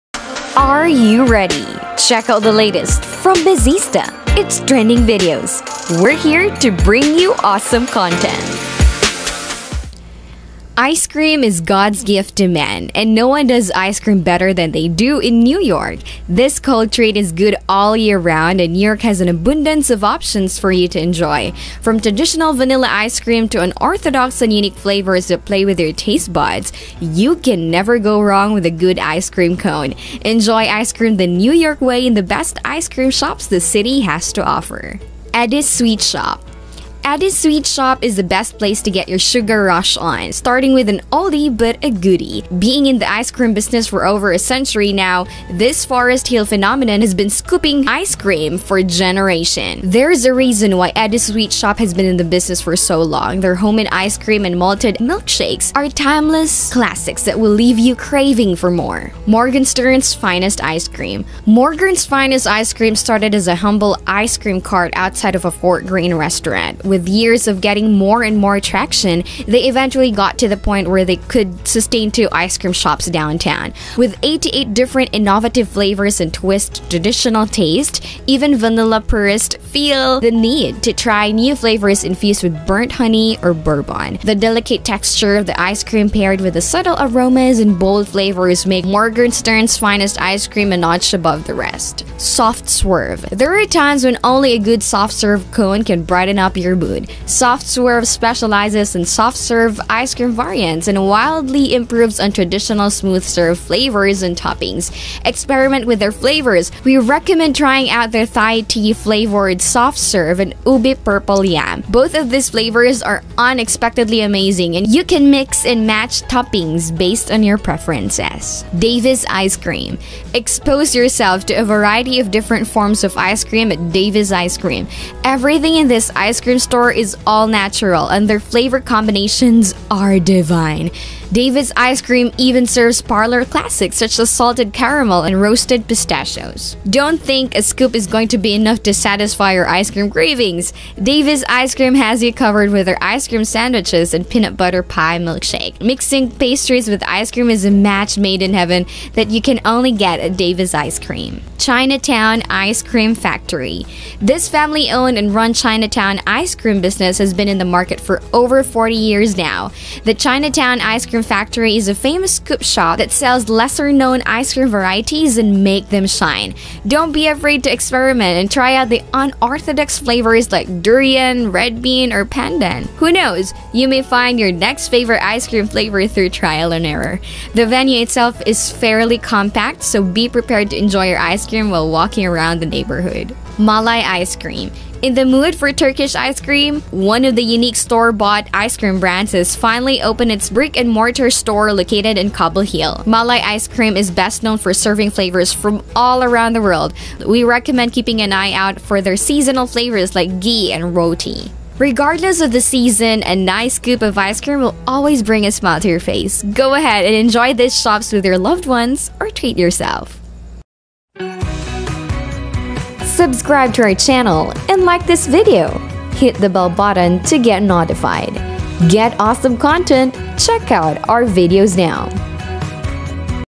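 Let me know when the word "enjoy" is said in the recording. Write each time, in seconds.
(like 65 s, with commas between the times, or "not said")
20 s, 30 s, 180 s, 207 s.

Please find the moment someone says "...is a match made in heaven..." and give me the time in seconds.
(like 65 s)
147 s.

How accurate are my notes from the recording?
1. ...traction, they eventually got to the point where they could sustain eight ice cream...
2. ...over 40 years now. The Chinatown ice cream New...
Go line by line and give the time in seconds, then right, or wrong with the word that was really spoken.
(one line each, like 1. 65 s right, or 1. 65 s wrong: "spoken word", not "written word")
1. 68 s wrong: "two", not "eight"
2. 158 s wrong: "Cream", not "New".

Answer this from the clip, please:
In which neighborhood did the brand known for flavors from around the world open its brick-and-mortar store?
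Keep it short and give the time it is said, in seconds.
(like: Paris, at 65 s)
Cobble Hill, at 192 s.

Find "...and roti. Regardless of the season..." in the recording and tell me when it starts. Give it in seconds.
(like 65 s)
200 s.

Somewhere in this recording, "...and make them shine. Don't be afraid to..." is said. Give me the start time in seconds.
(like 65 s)
165 s.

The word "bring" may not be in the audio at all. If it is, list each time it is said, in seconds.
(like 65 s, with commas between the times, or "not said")
6 s, 205 s.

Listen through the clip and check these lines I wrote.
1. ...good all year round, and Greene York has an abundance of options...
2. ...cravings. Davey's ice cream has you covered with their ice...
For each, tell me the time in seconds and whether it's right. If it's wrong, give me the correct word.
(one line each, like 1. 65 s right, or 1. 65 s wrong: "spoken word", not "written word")
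1. 17 s wrong: "New", not "Greene"
2. 140 s right.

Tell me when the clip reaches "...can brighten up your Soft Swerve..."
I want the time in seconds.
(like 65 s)
95 s.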